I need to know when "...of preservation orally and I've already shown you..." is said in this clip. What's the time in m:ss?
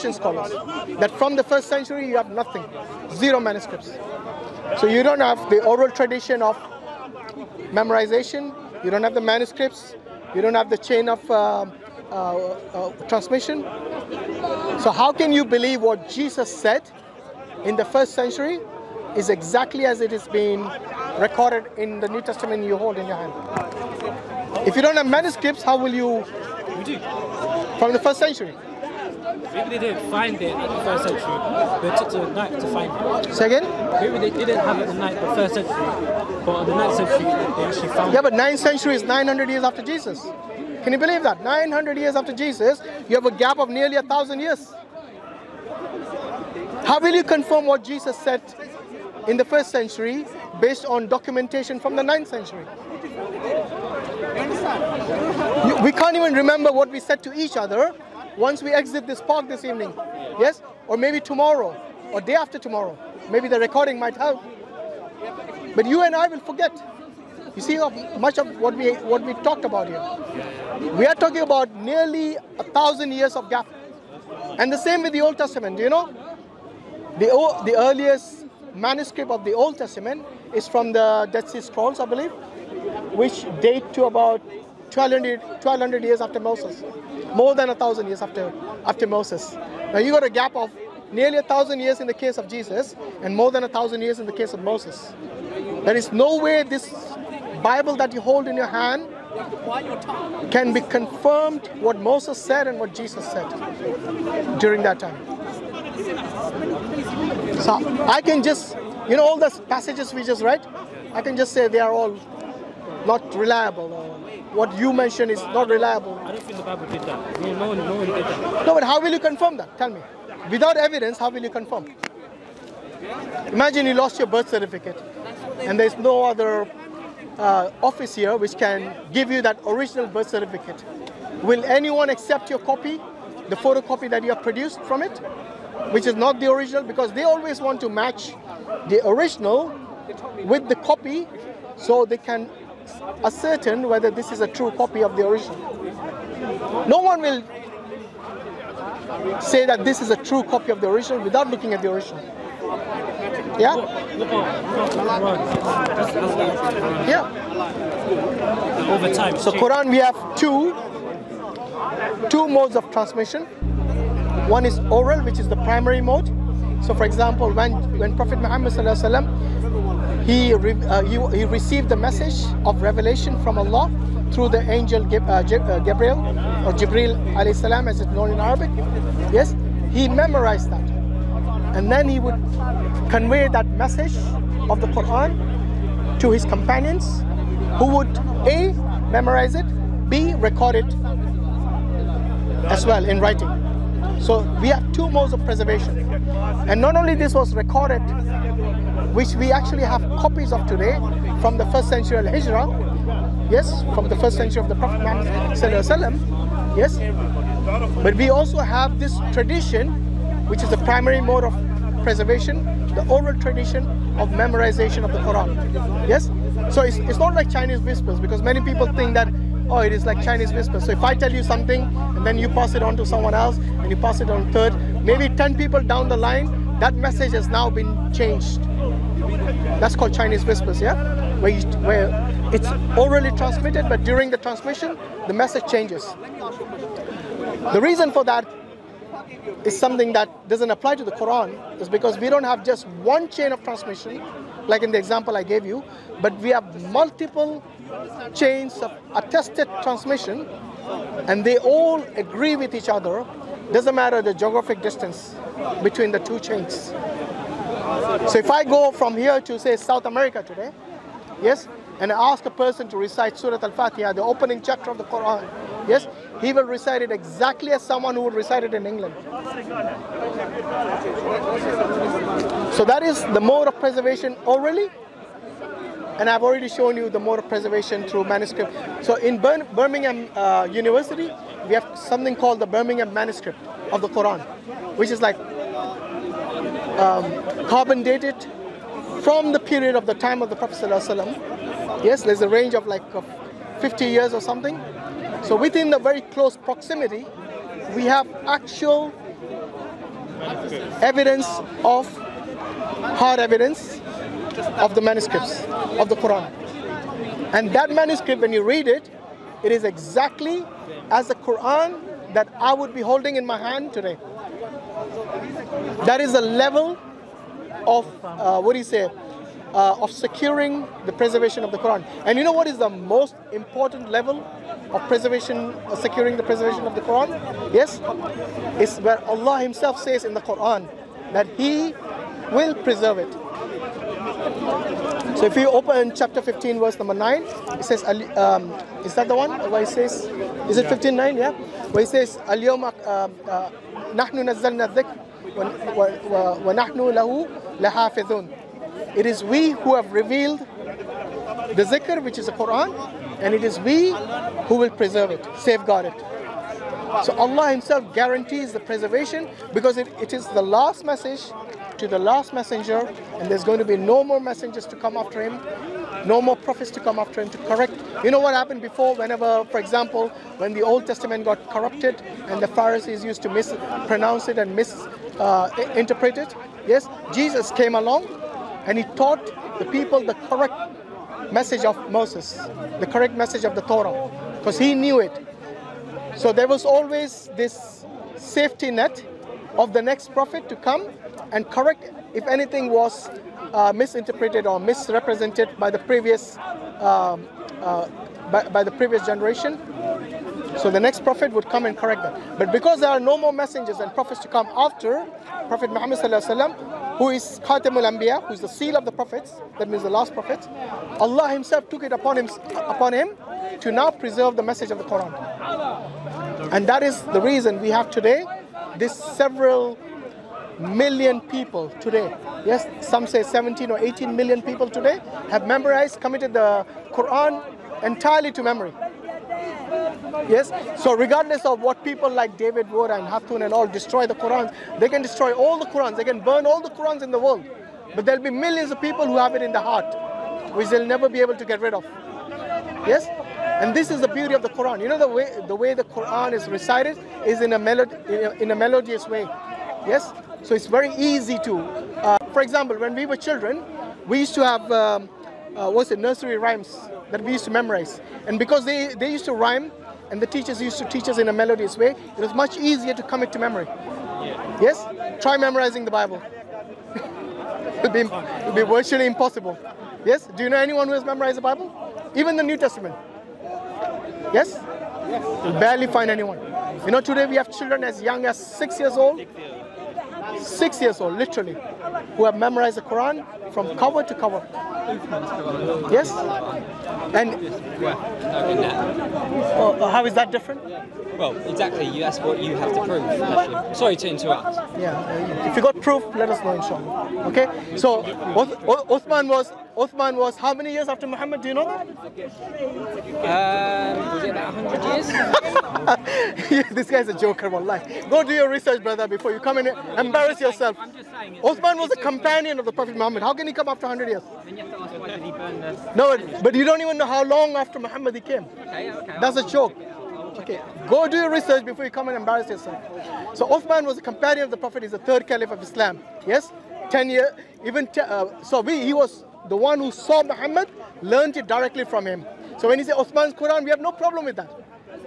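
4:33.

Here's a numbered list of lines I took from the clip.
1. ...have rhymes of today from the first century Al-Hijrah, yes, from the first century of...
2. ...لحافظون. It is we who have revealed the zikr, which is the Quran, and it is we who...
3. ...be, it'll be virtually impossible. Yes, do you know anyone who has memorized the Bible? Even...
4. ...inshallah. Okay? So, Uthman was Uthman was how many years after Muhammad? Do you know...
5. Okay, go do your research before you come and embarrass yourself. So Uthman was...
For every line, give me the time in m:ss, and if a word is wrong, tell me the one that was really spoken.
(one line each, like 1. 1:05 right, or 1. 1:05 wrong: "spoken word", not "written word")
1. 3:19 wrong: "copies", not "rhymes"
2. 5:47 right
3. 7:48 right
4. 8:16 right
5. 8:40 right.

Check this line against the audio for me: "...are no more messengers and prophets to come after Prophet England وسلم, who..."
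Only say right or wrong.
wrong.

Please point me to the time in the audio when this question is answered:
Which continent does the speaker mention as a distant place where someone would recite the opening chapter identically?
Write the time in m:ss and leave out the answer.
4:19.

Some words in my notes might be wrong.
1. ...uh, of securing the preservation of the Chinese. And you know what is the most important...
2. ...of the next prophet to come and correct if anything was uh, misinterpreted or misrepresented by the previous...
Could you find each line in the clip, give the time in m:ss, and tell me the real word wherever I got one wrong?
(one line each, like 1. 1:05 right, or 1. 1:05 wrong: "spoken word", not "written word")
1. 5:19 wrong: "Quran", not "Chinese"
2. 6:29 right.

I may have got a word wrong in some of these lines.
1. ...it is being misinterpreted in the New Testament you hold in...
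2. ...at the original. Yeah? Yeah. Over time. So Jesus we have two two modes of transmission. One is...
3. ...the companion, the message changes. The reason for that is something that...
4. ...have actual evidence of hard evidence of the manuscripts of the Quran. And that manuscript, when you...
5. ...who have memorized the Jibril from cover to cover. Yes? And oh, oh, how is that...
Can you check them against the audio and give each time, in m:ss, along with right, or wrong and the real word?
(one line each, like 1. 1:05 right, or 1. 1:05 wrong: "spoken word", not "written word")
1. 0:20 wrong: "recorded", not "misinterpreted"
2. 2:31 wrong: "Quran", not "Jesus"
3. 3:54 wrong: "transmission", not "companion"
4. 4:58 right
5. 8:02 wrong: "Quran", not "Jibril".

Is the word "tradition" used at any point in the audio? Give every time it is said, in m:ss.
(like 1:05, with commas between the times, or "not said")
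0:05, 3:29, 3:33.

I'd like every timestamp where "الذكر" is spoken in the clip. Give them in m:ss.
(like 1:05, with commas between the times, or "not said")
5:44.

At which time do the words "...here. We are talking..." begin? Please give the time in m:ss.
1:09.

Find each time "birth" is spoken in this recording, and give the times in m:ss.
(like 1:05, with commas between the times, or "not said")
2:04, 2:10.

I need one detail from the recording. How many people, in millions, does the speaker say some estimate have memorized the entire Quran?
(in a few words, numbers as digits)
17 or 18 million.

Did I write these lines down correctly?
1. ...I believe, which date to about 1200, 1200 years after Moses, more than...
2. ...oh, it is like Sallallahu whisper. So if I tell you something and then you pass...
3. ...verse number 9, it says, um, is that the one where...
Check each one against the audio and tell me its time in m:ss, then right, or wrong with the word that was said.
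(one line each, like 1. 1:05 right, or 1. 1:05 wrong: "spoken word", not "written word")
1. 1:21 right
2. 3:39 wrong: "Chinese", not "Sallallahu"
3. 5:36 right.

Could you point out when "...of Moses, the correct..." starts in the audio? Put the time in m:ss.
6:21.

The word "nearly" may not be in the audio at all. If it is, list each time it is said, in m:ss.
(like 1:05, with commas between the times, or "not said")
0:43, 1:11, 1:31.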